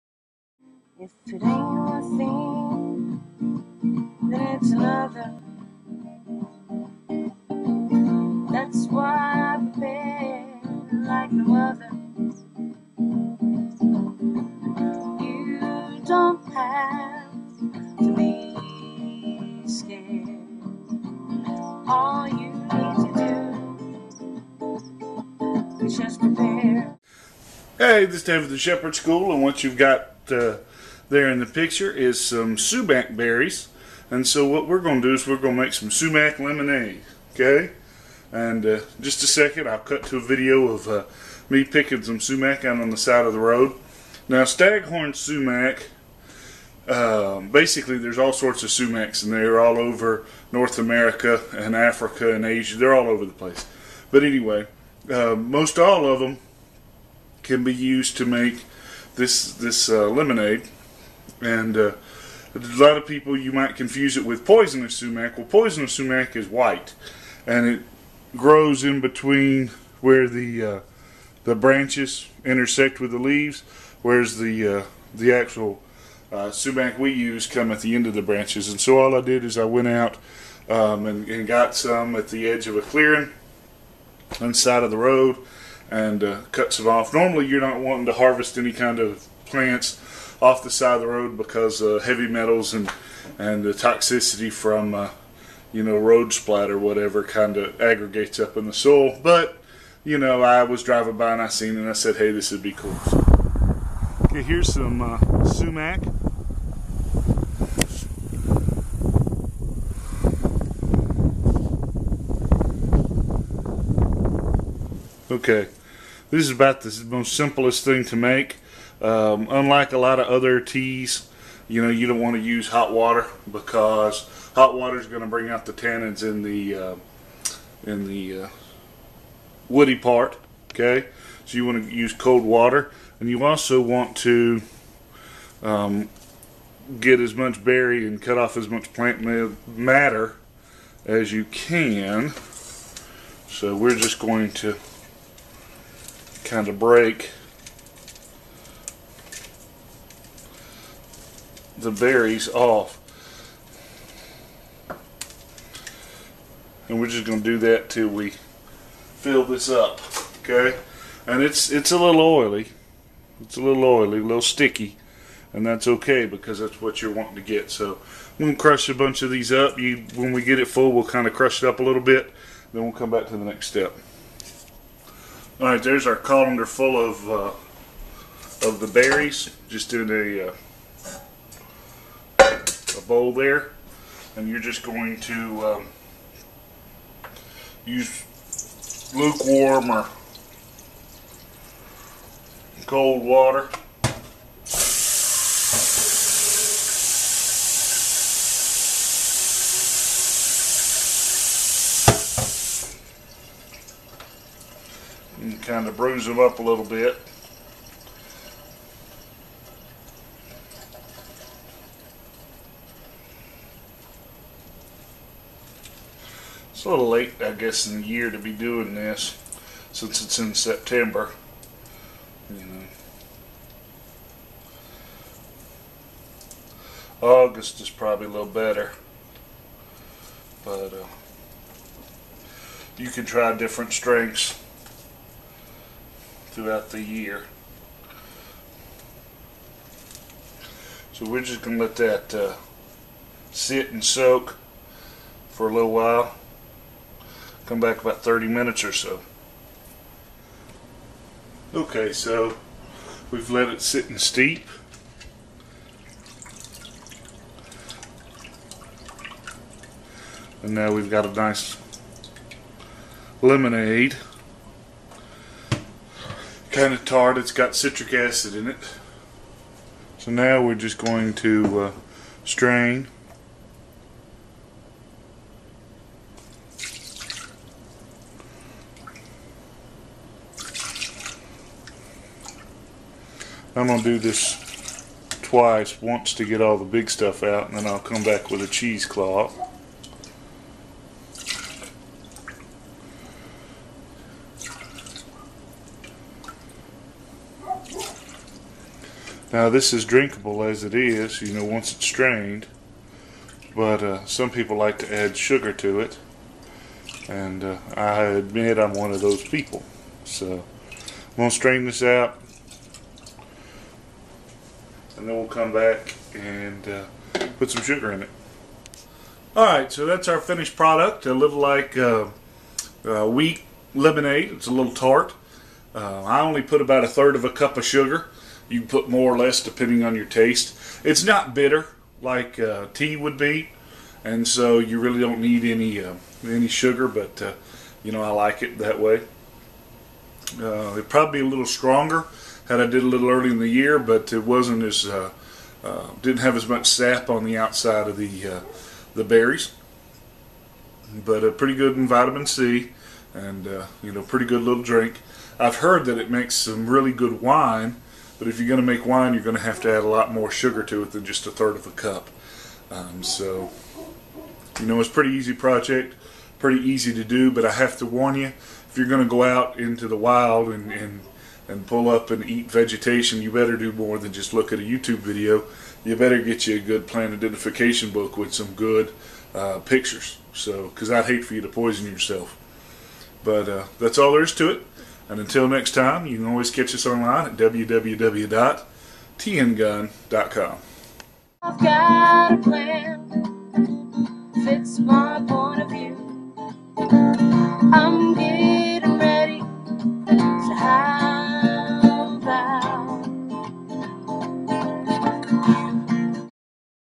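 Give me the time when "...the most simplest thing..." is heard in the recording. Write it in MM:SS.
01:56.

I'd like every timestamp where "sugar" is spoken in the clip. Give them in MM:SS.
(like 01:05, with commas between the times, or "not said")
05:05, 05:17, 05:27, 05:36, 06:00.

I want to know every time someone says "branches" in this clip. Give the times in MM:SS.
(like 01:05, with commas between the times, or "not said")
01:11, 01:18.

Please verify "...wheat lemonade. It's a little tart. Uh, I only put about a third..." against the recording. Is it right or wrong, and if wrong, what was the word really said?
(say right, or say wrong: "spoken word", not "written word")
right.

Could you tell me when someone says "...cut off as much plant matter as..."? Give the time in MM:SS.
02:18.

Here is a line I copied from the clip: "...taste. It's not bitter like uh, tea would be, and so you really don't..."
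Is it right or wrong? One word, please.
right.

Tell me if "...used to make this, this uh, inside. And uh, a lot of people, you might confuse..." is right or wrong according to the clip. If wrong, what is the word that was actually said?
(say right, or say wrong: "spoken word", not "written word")
wrong: "lemonade", not "inside".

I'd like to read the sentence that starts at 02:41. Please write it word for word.
And it's it's a little oily.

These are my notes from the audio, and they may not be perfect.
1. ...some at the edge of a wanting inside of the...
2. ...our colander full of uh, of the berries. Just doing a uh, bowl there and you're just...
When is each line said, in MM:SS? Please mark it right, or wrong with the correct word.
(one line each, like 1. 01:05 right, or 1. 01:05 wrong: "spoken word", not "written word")
1. 01:21 wrong: "clearing", not "wanting"
2. 02:56 right.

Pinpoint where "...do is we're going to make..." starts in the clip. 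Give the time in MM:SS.
00:35.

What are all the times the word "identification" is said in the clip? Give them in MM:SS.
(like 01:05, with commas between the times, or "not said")
06:17.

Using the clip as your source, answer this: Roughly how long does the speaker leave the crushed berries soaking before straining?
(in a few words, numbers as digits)
30 minutes.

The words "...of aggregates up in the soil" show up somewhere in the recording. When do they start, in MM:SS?
01:37.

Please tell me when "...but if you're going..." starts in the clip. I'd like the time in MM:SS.
05:58.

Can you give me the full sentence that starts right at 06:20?
So, because I'd hate for you to poison yourself.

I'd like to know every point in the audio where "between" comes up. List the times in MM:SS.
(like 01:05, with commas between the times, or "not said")
01:09.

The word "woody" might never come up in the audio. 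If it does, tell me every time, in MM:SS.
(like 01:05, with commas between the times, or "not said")
02:09.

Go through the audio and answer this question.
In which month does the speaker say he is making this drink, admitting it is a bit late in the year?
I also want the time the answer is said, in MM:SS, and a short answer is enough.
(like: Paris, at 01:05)
September, at 03:40.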